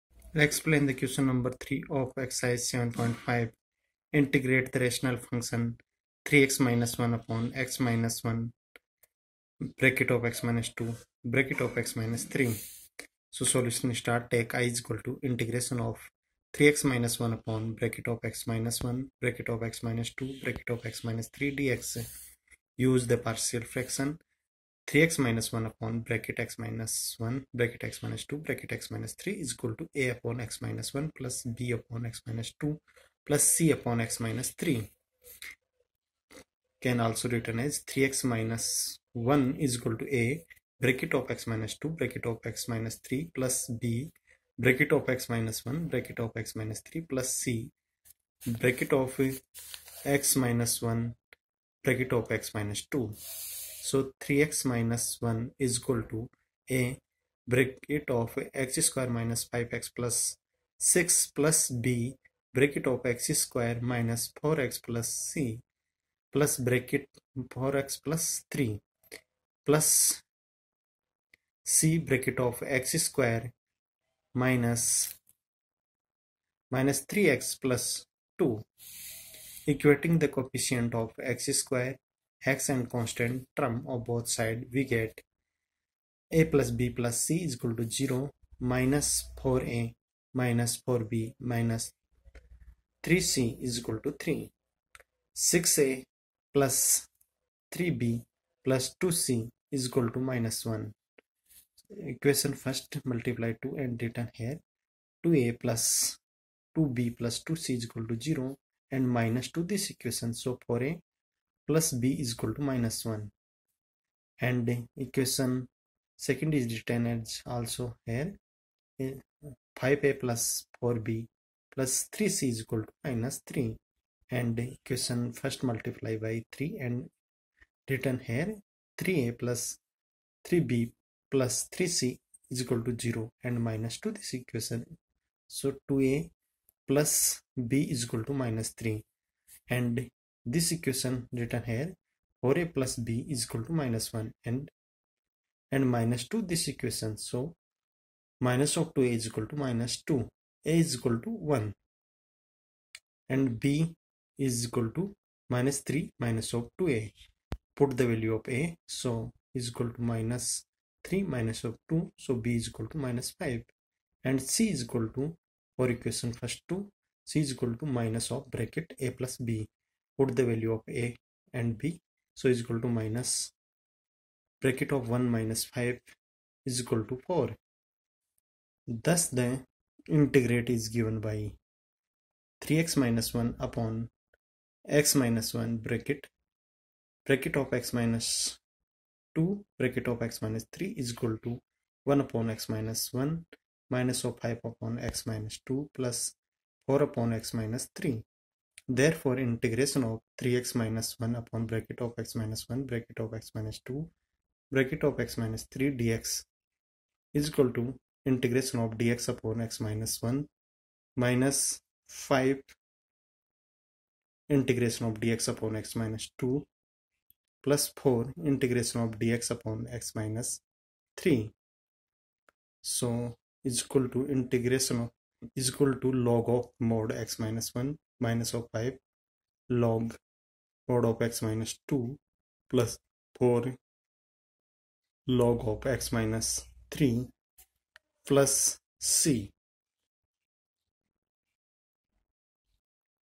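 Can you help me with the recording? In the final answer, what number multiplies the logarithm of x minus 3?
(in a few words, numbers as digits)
4.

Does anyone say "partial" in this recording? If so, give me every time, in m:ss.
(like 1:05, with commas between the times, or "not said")
0:23.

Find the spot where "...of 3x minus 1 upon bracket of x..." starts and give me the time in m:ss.
0:15.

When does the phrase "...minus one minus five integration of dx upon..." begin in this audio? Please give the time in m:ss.
3:29.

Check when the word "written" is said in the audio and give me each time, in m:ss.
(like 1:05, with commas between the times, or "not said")
0:37, 1:56, 2:07, 2:21.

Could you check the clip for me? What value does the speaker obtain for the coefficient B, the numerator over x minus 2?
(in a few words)
-5.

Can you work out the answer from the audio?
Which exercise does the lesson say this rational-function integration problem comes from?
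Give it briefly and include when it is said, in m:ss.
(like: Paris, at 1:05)
7.5, at 0:02.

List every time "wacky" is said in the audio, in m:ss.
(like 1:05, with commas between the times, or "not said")
not said.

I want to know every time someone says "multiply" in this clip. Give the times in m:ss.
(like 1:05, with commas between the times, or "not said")
1:43, 2:05.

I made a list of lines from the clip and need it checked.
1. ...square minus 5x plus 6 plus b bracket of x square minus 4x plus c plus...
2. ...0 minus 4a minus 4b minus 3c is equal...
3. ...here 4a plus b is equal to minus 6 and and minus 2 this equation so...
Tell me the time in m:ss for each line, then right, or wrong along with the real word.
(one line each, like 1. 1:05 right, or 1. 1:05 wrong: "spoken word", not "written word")
1. 0:58 right
2. 1:27 right
3. 2:21 wrong: "1", not "6".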